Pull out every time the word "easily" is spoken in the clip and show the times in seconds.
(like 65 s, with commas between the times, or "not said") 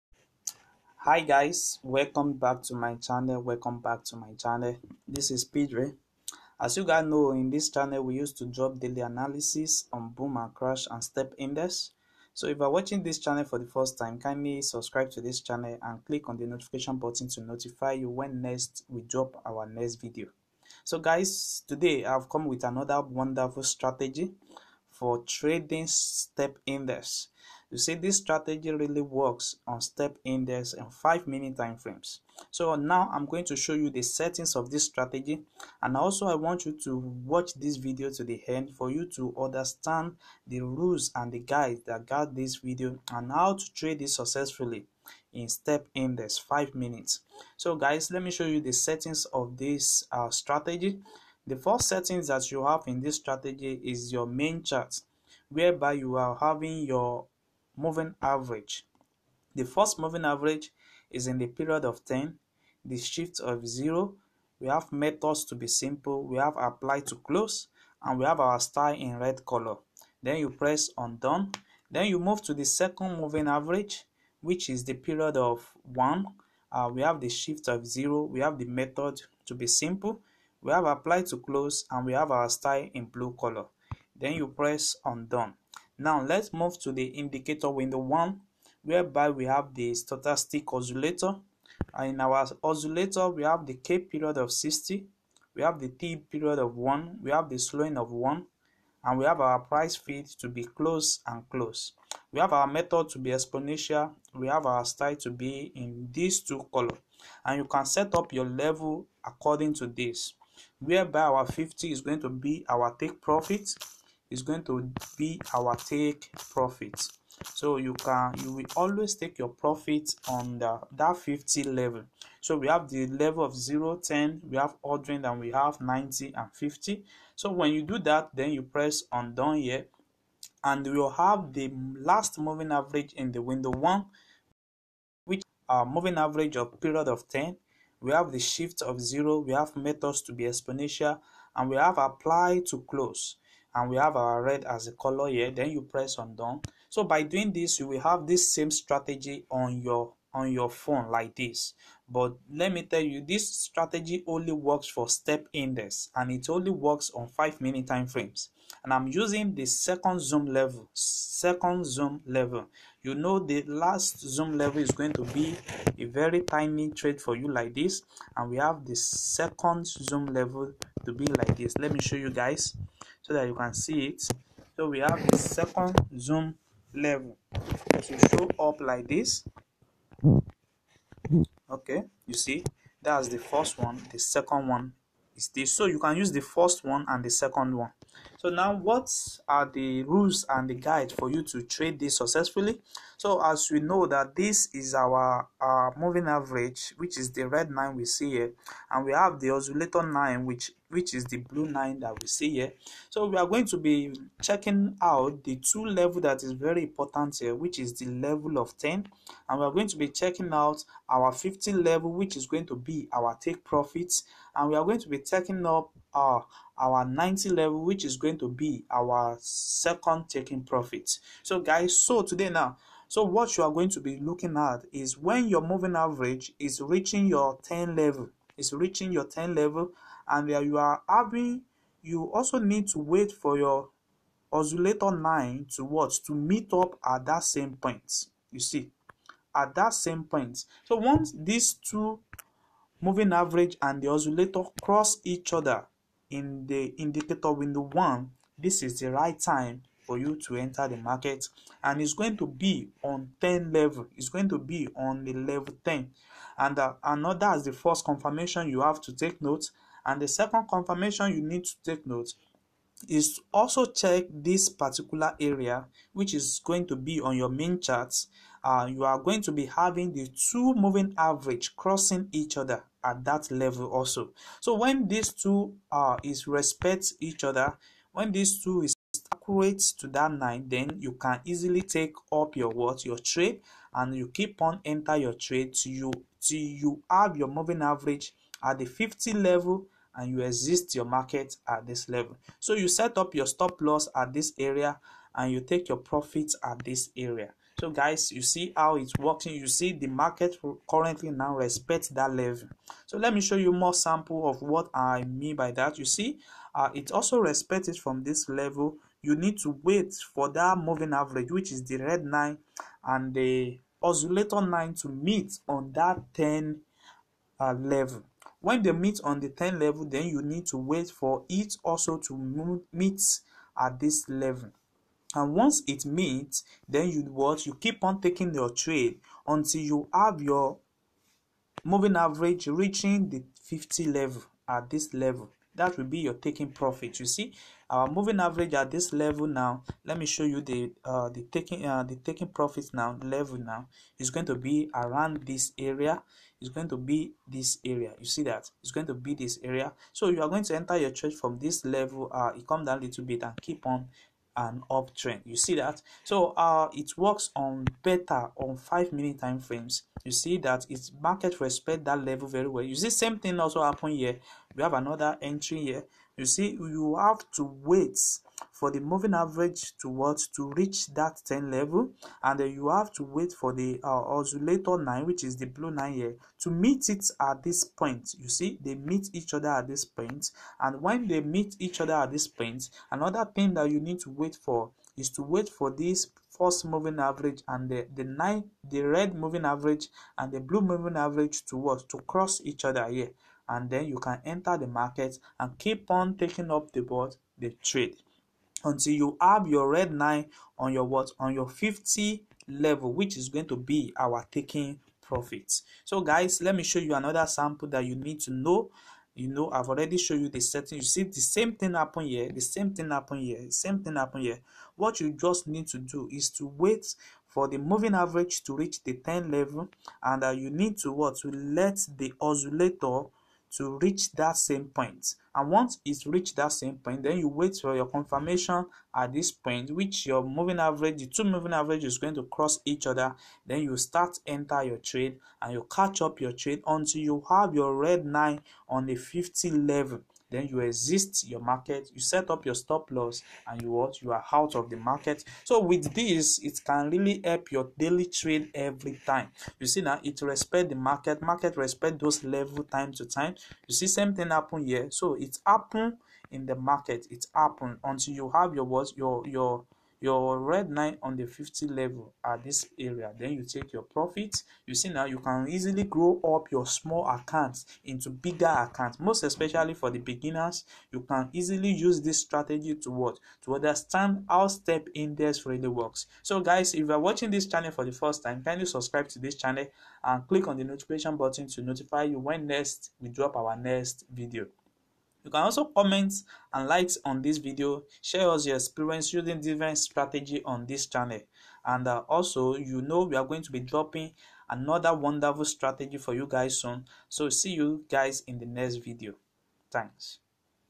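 281 s, 465 s, 471 s.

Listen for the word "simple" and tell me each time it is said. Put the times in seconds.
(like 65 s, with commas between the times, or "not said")
65 s, 79 s.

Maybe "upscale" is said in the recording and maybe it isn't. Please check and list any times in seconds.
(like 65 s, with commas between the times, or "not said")
not said.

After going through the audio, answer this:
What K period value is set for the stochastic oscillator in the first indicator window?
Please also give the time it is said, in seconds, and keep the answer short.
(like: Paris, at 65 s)
60, at 93 s.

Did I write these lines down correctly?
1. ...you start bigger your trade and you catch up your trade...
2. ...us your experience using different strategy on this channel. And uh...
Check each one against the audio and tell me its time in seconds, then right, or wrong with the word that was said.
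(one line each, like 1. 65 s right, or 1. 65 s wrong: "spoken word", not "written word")
1. 433 s wrong: "enter", not "bigger"
2. 488 s right.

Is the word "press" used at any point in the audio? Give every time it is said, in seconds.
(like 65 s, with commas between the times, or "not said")
70 s, 84 s, 128 s, 145 s.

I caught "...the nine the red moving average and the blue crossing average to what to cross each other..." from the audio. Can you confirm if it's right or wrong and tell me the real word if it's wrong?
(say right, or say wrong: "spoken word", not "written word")
wrong: "moving", not "crossing".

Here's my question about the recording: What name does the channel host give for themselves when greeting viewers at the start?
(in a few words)
Peedrey.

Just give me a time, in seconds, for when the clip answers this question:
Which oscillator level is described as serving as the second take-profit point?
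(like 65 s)
217 s.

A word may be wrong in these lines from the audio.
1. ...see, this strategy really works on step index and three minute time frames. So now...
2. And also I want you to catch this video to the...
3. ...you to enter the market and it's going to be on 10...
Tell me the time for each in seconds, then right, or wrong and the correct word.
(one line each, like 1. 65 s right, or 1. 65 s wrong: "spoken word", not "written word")
1. 27 s wrong: "five", not "three"
2. 35 s wrong: "watch", not "catch"
3. 250 s right.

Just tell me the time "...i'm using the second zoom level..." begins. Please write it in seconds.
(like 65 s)
158 s.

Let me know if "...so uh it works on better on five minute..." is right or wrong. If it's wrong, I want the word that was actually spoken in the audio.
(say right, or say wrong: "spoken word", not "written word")
right.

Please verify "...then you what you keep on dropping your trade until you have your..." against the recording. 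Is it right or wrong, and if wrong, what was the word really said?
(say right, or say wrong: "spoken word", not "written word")
wrong: "taking", not "dropping".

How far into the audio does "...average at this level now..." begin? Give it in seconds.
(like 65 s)
338 s.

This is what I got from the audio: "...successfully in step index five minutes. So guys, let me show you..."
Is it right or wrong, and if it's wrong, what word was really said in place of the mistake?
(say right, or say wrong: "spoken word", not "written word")
right.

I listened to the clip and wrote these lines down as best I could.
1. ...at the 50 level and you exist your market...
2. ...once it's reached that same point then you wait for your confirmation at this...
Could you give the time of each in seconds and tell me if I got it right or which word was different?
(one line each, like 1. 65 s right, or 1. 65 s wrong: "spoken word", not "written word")
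1. 288 s right
2. 425 s right.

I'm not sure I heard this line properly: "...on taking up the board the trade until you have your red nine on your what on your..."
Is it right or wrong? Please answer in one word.
right.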